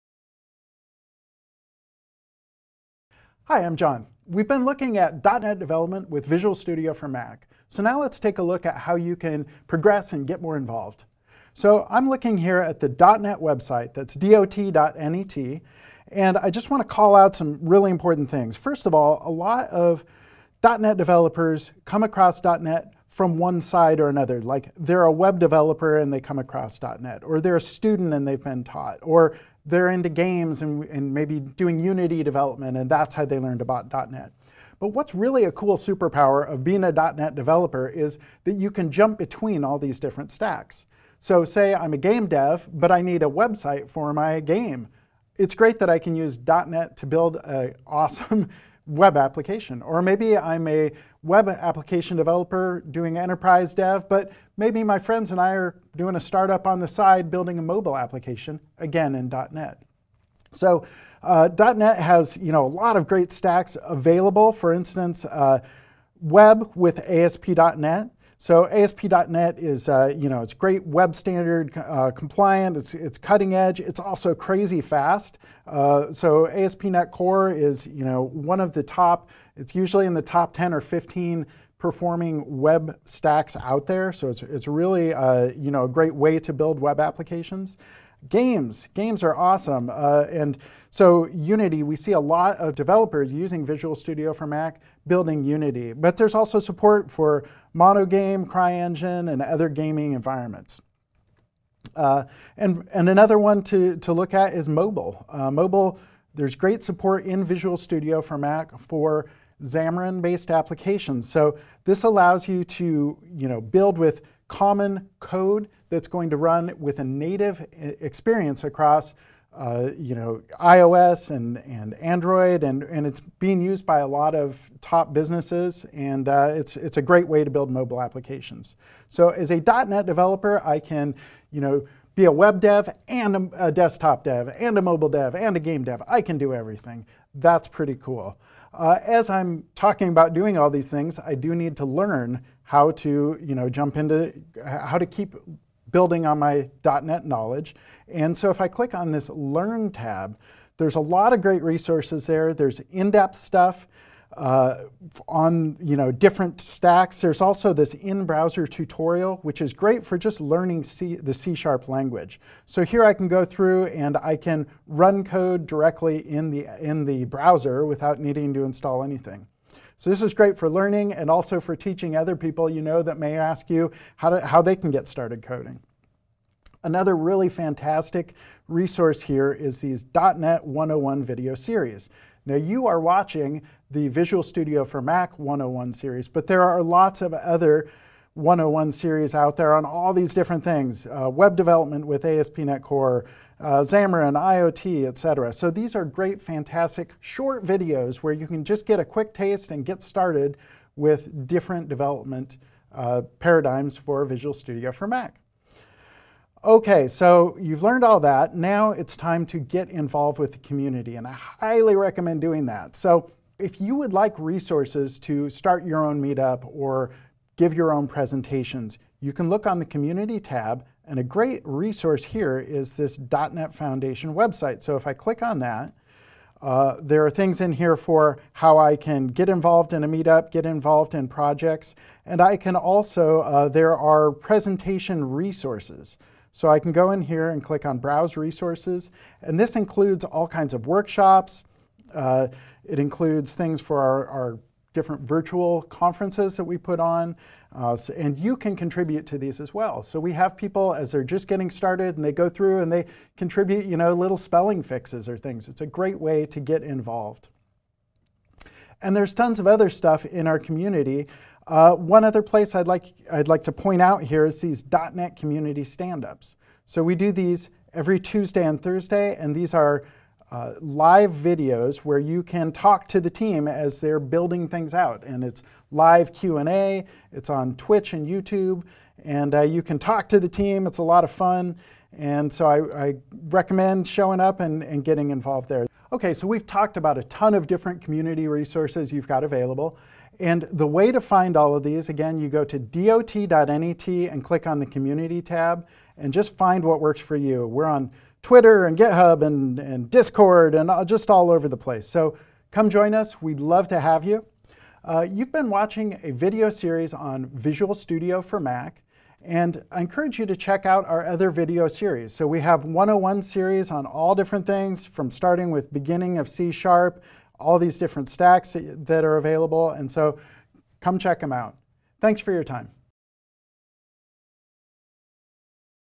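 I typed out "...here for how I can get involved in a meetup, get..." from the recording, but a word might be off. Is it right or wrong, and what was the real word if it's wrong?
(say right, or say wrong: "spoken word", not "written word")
right.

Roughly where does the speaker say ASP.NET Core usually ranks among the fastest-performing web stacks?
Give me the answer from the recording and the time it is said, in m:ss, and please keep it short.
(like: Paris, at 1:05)
Top 10 or 15, at 1:20.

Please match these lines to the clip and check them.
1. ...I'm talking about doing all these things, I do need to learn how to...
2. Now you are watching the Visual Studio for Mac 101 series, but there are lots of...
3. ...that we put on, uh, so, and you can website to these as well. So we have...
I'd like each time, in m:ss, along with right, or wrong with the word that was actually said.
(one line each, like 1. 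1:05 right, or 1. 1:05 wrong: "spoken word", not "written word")
1. 2:19 right
2. 3:02 right
3. 4:06 wrong: "contribute", not "website".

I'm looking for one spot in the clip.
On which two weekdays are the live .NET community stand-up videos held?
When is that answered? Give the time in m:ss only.
4:28.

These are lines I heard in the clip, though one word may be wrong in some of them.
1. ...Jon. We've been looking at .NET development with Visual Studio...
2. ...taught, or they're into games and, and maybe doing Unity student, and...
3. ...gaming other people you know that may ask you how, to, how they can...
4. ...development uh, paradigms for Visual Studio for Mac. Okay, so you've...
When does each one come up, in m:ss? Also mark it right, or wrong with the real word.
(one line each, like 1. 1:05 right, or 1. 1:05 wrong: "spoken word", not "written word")
1. 0:03 right
2. 0:28 wrong: "development", not "student"
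3. 2:51 wrong: "teaching", not "gaming"
4. 3:21 right.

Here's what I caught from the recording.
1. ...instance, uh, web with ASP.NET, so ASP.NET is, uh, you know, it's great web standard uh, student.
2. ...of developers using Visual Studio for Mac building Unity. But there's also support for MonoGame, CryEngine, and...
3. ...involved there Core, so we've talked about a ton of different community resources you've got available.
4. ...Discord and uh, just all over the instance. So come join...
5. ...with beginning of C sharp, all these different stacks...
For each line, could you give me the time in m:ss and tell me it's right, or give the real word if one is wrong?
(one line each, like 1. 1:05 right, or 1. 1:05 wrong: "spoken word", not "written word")
1. 1:04 wrong: "compliant", not "student"
2. 1:32 right
3. 4:45 wrong: "Okay", not "Core"
4. 5:00 wrong: "place", not "instance"
5. 5:15 right.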